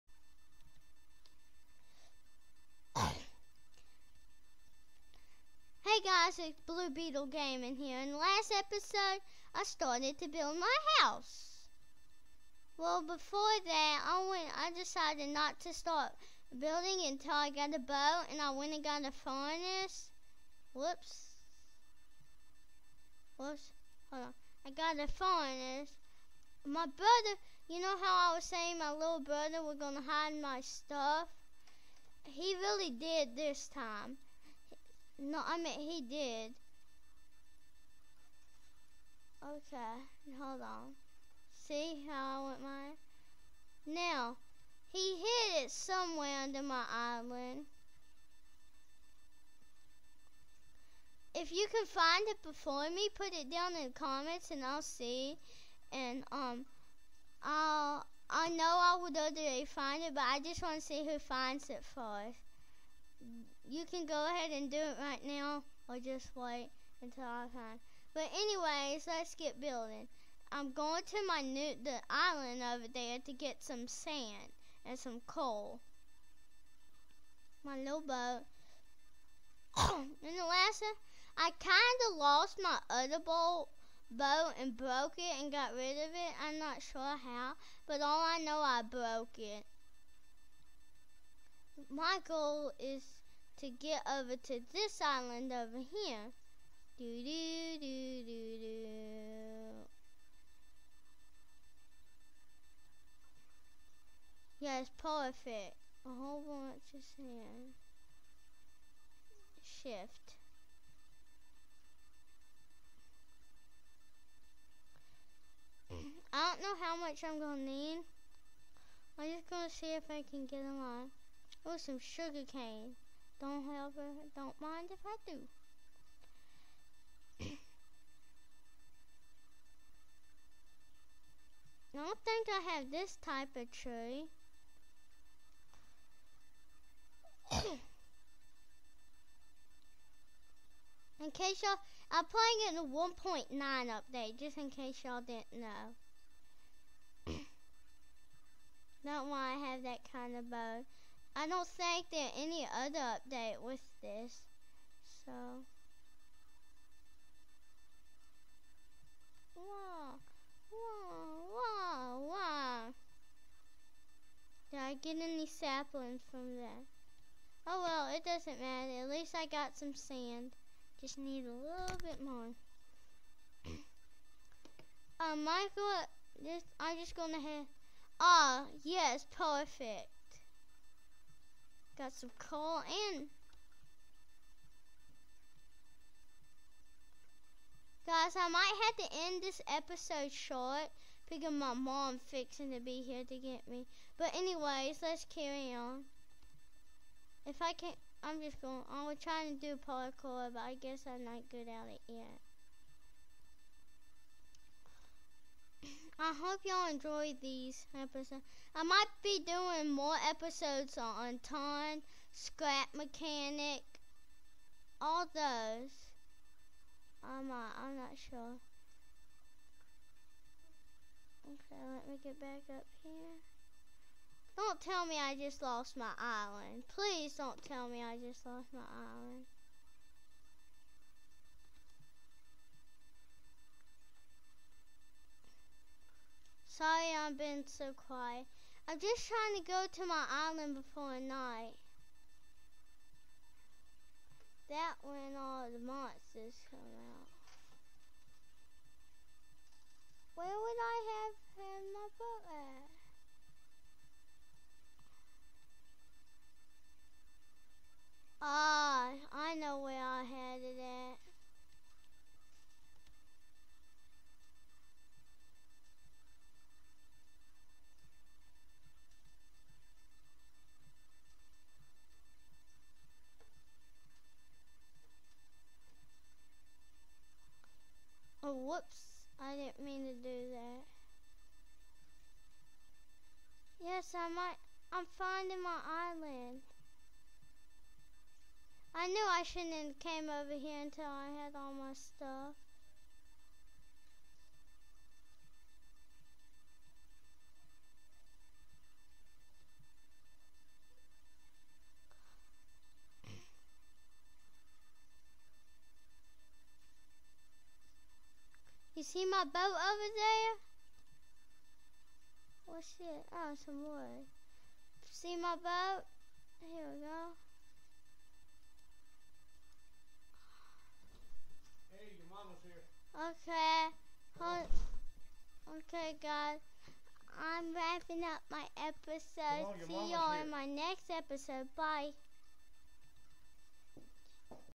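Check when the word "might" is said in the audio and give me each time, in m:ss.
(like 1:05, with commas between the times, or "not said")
3:08, 3:28, 3:37, 4:44.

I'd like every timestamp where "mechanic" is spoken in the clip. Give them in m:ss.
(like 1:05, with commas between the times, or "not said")
3:32.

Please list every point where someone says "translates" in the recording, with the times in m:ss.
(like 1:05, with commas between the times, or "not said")
not said.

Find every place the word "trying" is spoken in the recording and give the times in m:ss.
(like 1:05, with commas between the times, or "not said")
3:19, 3:59.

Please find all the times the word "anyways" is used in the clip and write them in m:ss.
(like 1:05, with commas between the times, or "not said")
1:08, 3:14.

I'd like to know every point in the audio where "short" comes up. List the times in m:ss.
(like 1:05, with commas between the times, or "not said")
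3:10.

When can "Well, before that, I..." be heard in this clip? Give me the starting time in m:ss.
0:12.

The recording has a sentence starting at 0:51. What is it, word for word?
If you can find it before me, put it down in the comments and I'll see.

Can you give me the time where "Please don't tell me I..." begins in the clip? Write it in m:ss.
3:46.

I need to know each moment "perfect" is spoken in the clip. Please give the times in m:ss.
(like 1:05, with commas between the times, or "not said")
1:45, 2:59.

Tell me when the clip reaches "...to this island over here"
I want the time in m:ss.
1:34.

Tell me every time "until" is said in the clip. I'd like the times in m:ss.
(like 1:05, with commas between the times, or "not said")
0:17, 1:07, 4:50.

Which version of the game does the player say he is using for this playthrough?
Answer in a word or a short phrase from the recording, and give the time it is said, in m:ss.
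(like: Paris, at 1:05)
1.9, at 2:22.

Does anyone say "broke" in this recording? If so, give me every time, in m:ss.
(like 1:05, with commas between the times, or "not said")
1:24, 1:28.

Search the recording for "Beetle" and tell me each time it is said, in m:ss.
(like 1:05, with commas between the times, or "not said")
0:06.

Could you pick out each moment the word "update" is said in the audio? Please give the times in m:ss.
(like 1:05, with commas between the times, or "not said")
2:23, 2:33.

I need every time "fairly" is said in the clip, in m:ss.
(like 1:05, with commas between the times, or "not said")
not said.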